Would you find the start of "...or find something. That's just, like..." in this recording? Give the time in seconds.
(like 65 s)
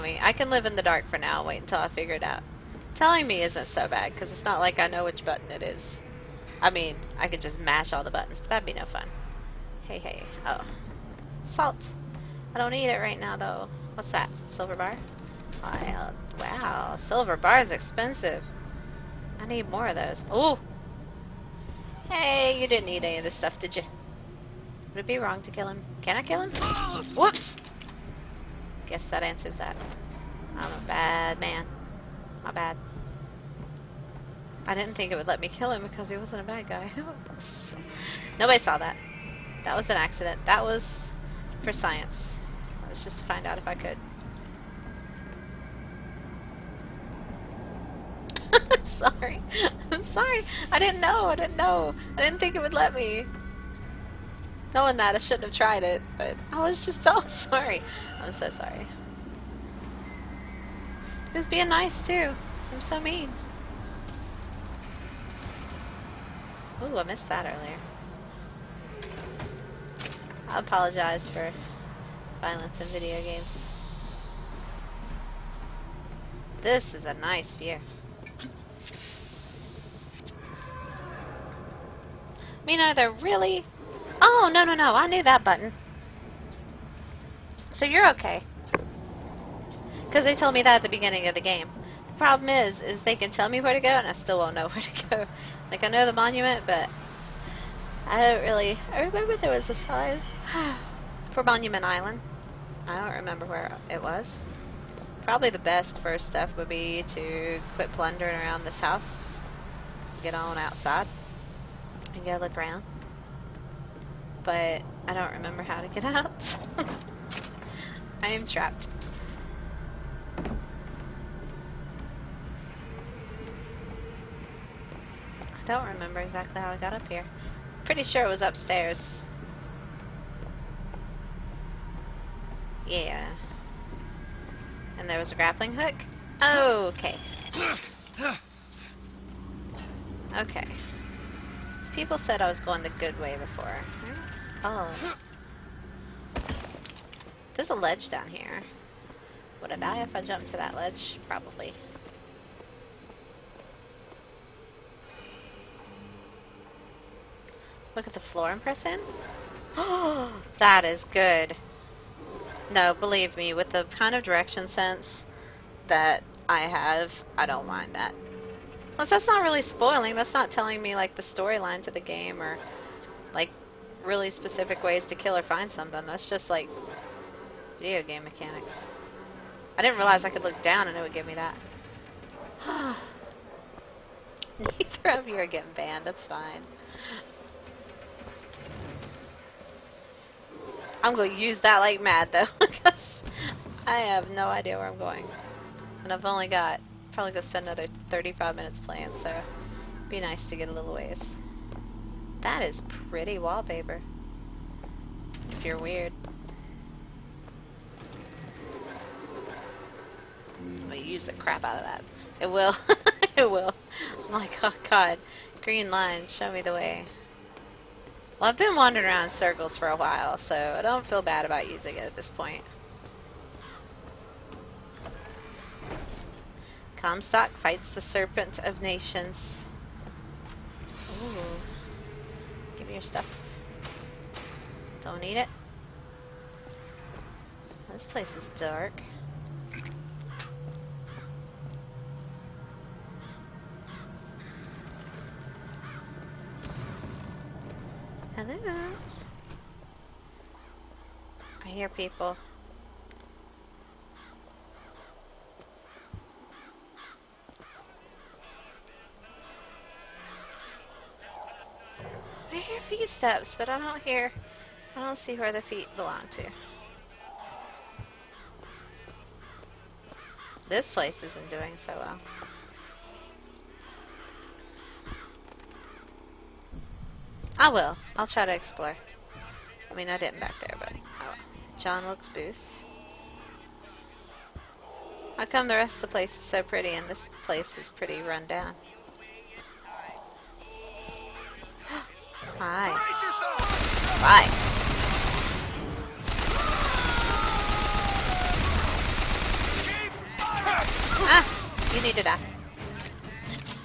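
175 s.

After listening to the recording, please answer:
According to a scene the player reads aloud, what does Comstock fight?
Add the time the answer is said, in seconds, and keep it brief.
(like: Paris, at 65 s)
The Serpent of Nations, at 228 s.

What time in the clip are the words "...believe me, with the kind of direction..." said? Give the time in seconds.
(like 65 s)
162 s.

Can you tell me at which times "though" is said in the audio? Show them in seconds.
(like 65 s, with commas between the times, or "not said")
13 s, 192 s.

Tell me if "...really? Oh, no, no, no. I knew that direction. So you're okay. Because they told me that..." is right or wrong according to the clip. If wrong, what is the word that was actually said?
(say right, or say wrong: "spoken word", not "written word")
wrong: "button", not "direction".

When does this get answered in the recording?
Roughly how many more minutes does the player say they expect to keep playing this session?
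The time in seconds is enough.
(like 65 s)
198 s.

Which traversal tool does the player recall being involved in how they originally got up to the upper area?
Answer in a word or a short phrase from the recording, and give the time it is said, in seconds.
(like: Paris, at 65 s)
Grappling hook, at 135 s.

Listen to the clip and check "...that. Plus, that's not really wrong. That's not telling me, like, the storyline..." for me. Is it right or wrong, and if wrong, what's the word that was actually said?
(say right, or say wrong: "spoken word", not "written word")
wrong: "spoiling", not "wrong".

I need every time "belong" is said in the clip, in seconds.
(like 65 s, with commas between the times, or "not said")
265 s.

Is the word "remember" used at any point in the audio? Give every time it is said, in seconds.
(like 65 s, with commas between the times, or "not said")
99 s, 103 s, 115 s, 125 s.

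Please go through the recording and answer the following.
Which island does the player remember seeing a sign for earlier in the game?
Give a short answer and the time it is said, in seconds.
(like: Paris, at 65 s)
Monument Island, at 101 s.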